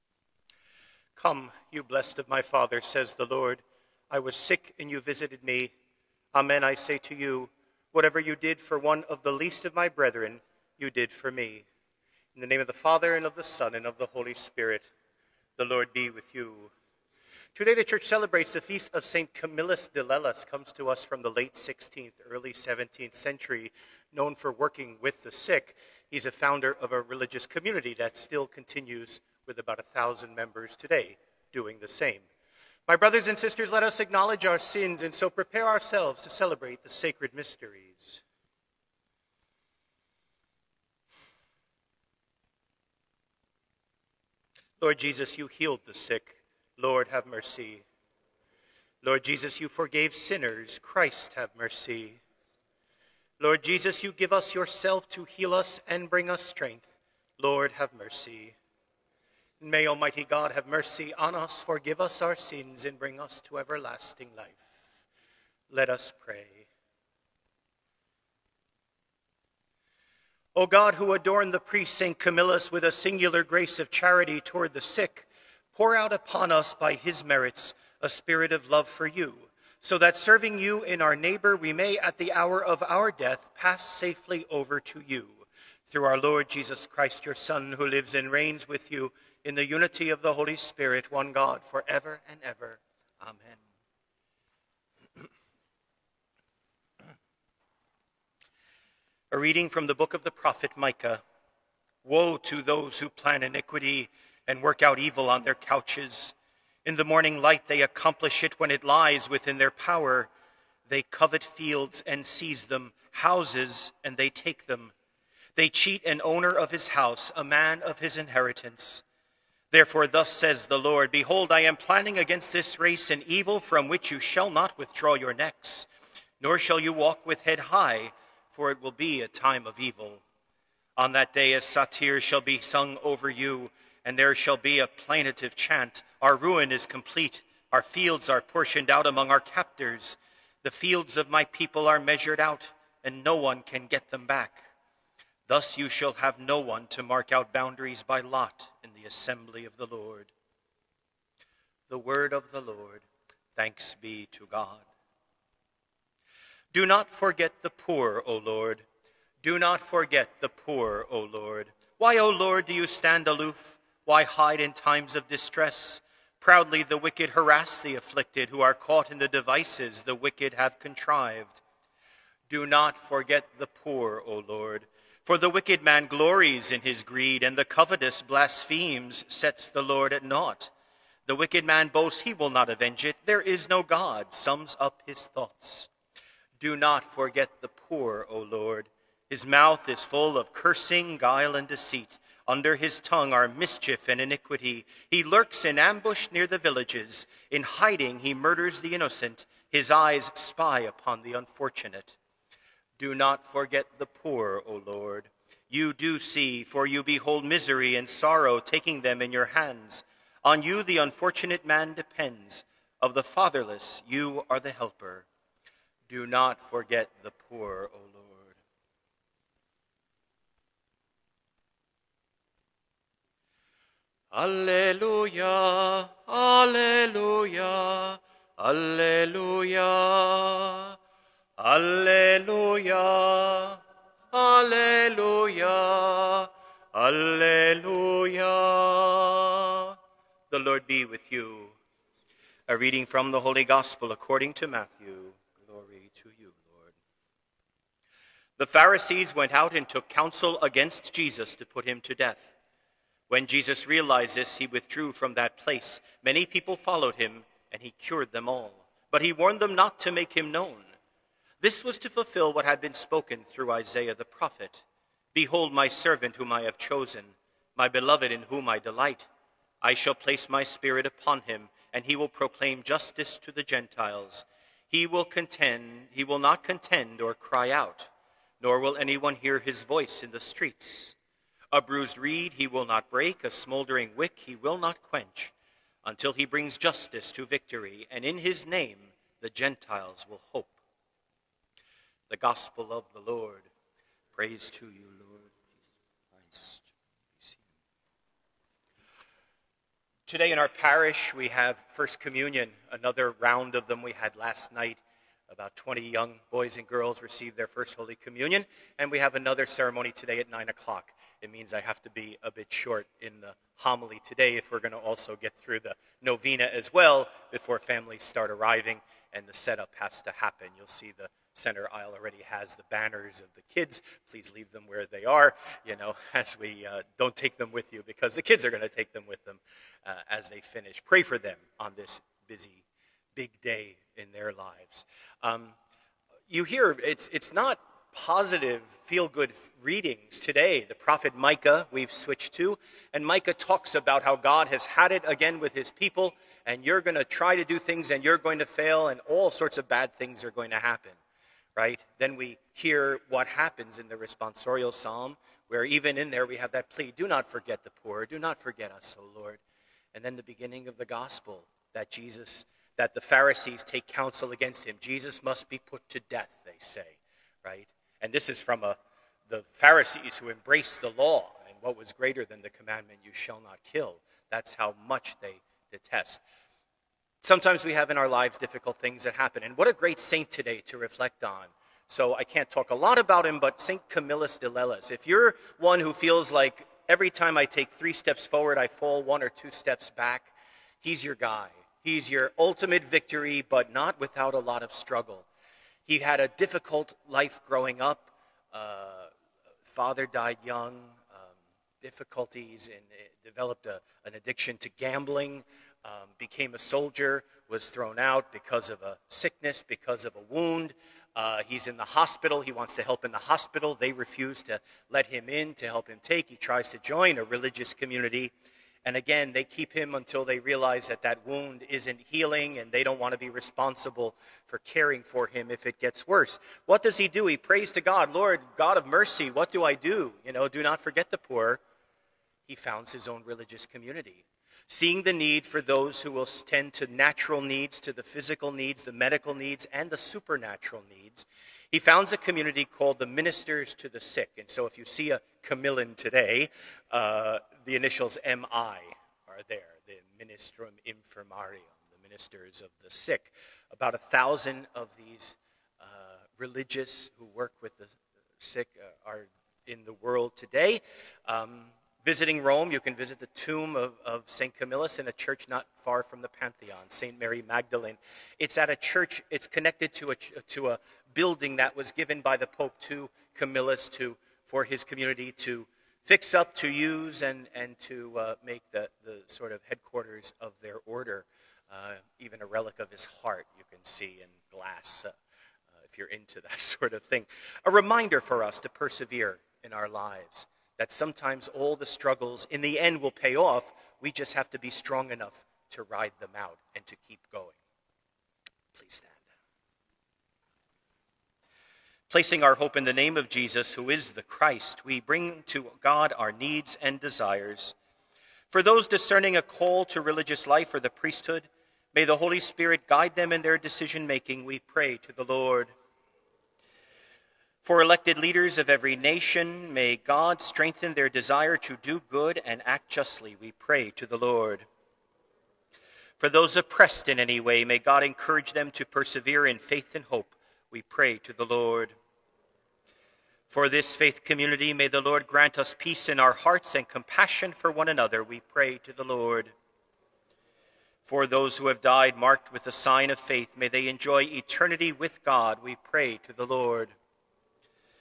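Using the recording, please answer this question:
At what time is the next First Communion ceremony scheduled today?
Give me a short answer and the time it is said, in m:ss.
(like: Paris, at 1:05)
9 o'clock, at 5:10.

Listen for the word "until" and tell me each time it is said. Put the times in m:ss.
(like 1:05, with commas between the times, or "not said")
4:46, 7:00.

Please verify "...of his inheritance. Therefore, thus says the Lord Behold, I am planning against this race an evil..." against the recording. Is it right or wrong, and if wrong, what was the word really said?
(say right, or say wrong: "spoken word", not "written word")
right.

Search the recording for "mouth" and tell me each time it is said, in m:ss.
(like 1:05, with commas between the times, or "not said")
3:09.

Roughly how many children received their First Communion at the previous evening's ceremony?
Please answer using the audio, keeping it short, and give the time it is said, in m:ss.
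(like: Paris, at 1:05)
20, at 5:05.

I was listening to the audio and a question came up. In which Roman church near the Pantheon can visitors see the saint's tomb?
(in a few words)
St. Mary Magdalene.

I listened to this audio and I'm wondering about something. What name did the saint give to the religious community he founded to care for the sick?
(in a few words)
Ministers to the Sick.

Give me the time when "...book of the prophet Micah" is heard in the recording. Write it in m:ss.
1:39.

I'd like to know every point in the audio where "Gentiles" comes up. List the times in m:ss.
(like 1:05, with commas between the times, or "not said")
4:33, 4:49.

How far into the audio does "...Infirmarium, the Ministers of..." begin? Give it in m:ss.
7:31.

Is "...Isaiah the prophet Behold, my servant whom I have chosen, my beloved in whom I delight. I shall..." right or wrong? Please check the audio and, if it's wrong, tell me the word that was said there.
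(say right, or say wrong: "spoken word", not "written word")
right.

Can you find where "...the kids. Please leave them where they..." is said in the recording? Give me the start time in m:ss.
5:23.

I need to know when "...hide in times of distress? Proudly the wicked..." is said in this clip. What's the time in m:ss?
2:44.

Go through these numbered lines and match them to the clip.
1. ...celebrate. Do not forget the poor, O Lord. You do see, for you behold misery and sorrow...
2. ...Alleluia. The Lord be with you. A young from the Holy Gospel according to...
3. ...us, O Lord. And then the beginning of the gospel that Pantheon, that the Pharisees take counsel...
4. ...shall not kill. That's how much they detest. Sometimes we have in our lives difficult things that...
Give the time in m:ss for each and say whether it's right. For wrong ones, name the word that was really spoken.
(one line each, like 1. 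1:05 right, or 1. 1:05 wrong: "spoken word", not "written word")
1. 3:21 wrong: "unfortunate", not "celebrate"
2. 3:56 wrong: "reading", not "young"
3. 5:58 wrong: "Jesus", not "Pantheon"
4. 6:13 right.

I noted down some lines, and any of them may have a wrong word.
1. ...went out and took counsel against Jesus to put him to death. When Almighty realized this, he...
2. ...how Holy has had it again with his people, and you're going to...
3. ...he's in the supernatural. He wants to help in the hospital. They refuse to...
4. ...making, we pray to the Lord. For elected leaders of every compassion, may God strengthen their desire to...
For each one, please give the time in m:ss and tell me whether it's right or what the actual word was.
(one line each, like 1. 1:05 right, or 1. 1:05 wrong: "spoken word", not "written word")
1. 4:09 wrong: "Jesus", not "Almighty"
2. 5:44 wrong: "God", not "Holy"
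3. 6:51 wrong: "hospital", not "supernatural"
4. 8:34 wrong: "nation", not "compassion".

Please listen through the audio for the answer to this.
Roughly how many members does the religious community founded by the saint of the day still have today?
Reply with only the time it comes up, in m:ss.
0:29.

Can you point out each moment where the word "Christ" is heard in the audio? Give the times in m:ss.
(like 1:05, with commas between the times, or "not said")
0:50, 1:26, 4:57, 8:24.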